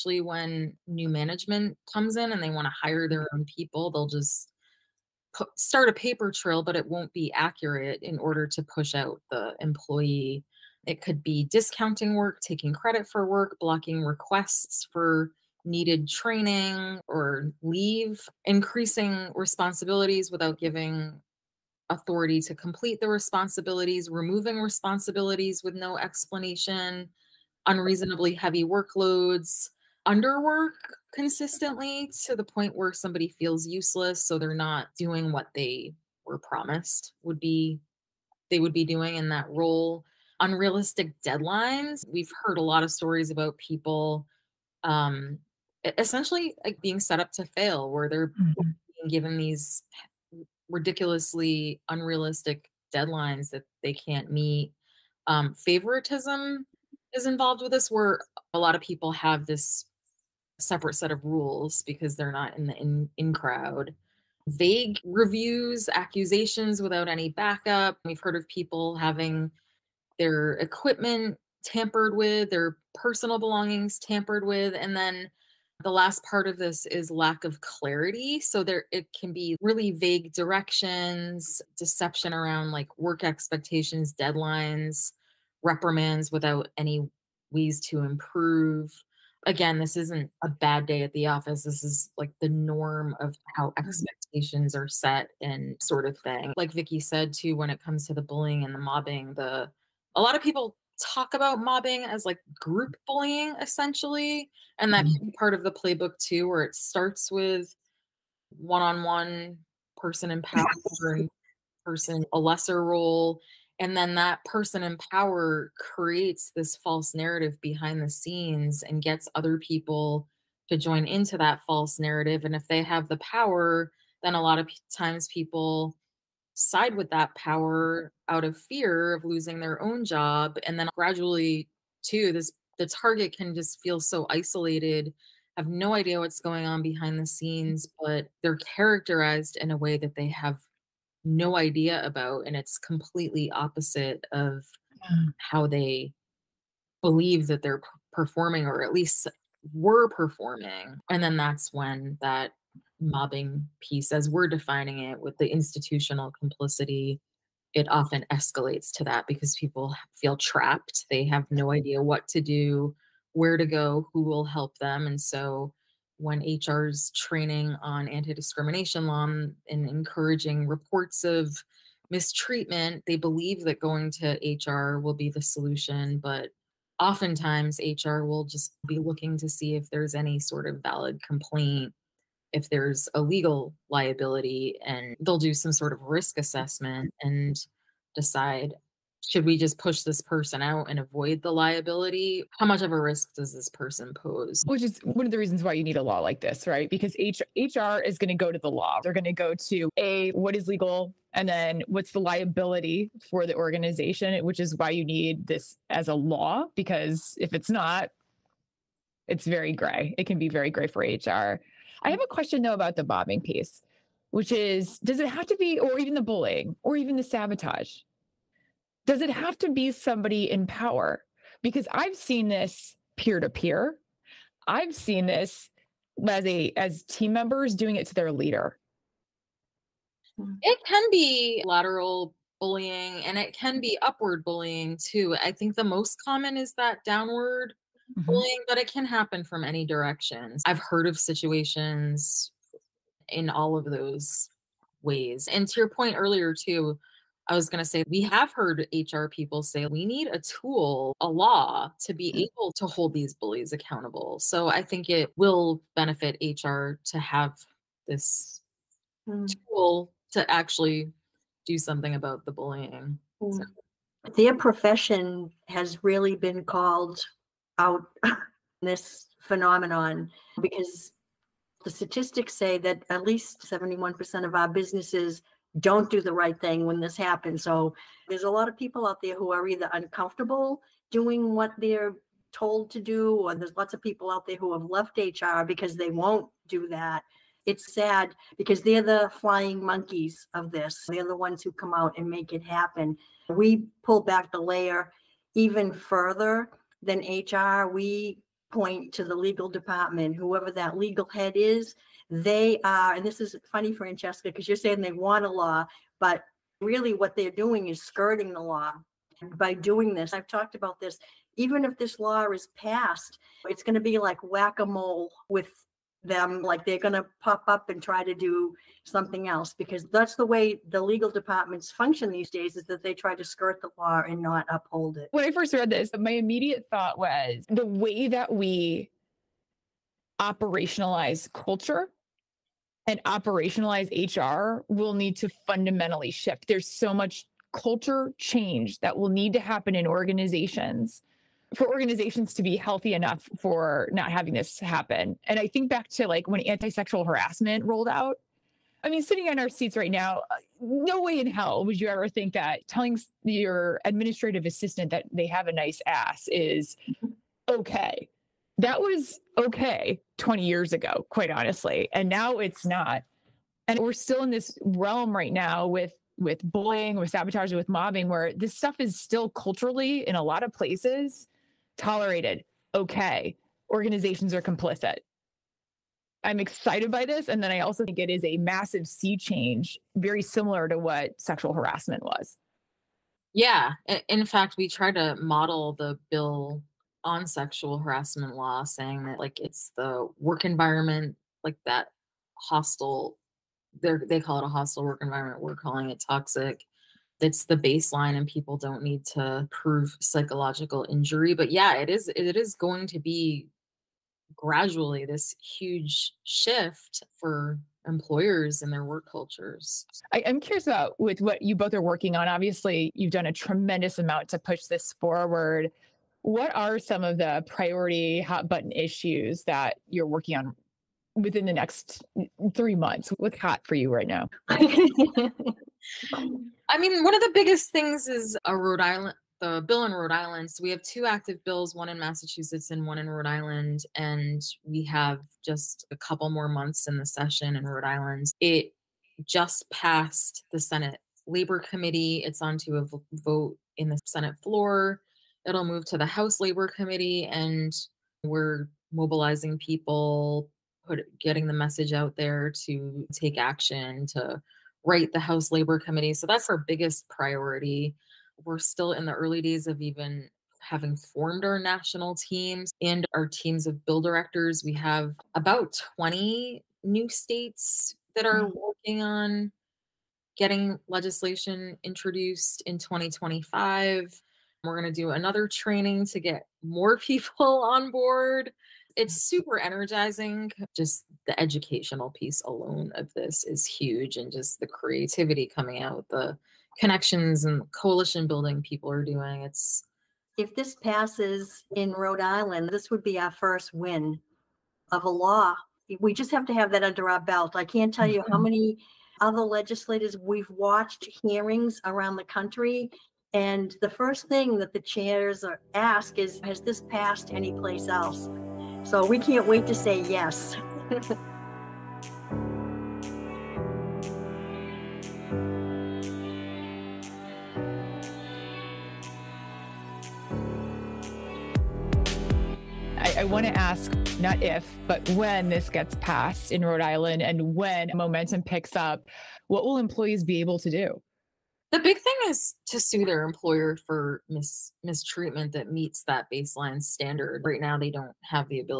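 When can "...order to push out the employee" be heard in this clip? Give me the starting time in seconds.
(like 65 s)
8 s.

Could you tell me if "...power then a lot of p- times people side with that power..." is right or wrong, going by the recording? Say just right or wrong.
right.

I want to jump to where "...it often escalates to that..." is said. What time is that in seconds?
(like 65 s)
157 s.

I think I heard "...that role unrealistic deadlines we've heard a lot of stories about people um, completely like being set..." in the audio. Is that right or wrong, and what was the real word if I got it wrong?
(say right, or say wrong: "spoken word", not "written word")
wrong: "essentially", not "completely".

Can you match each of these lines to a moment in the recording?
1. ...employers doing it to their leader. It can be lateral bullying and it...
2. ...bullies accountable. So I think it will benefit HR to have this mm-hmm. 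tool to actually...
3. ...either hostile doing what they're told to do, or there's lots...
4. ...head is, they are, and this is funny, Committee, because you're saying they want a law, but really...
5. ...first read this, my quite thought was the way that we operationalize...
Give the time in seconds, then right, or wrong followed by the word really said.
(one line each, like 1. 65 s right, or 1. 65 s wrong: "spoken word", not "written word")
1. 227 s wrong: "members", not "employers"
2. 253 s right
3. 279 s wrong: "uncomfortable", not "hostile"
4. 301 s wrong: "Francesca", not "Committee"
5. 325 s wrong: "immediate", not "quite".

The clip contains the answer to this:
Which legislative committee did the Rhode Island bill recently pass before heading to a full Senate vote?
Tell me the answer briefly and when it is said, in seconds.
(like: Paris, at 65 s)
Senate Labor Committee, at 440 s.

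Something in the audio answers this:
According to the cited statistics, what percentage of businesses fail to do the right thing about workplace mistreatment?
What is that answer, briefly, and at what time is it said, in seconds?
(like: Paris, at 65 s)
71%, at 273 s.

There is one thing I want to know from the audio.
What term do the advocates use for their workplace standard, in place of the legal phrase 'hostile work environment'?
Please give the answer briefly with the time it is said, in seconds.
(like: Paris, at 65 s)
Toxic, at 396 s.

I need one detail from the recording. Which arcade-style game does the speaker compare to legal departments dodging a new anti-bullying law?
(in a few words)
Whack a mole.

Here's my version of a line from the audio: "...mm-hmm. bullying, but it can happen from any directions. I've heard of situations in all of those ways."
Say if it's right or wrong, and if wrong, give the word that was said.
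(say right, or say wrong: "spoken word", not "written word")
right.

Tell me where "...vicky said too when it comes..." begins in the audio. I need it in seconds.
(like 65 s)
96 s.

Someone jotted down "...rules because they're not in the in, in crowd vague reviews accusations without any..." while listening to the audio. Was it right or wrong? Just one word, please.
right.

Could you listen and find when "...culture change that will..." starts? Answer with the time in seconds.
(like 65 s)
337 s.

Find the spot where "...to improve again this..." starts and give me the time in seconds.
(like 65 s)
87 s.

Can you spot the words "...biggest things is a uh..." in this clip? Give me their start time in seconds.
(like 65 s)
427 s.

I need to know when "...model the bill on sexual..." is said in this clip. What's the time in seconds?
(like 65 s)
385 s.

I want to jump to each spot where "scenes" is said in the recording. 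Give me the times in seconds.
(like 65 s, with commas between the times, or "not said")
118 s, 137 s.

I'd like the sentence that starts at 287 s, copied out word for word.
It's sad because they're the flying monkeys of this.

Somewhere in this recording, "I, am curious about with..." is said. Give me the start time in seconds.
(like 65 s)
410 s.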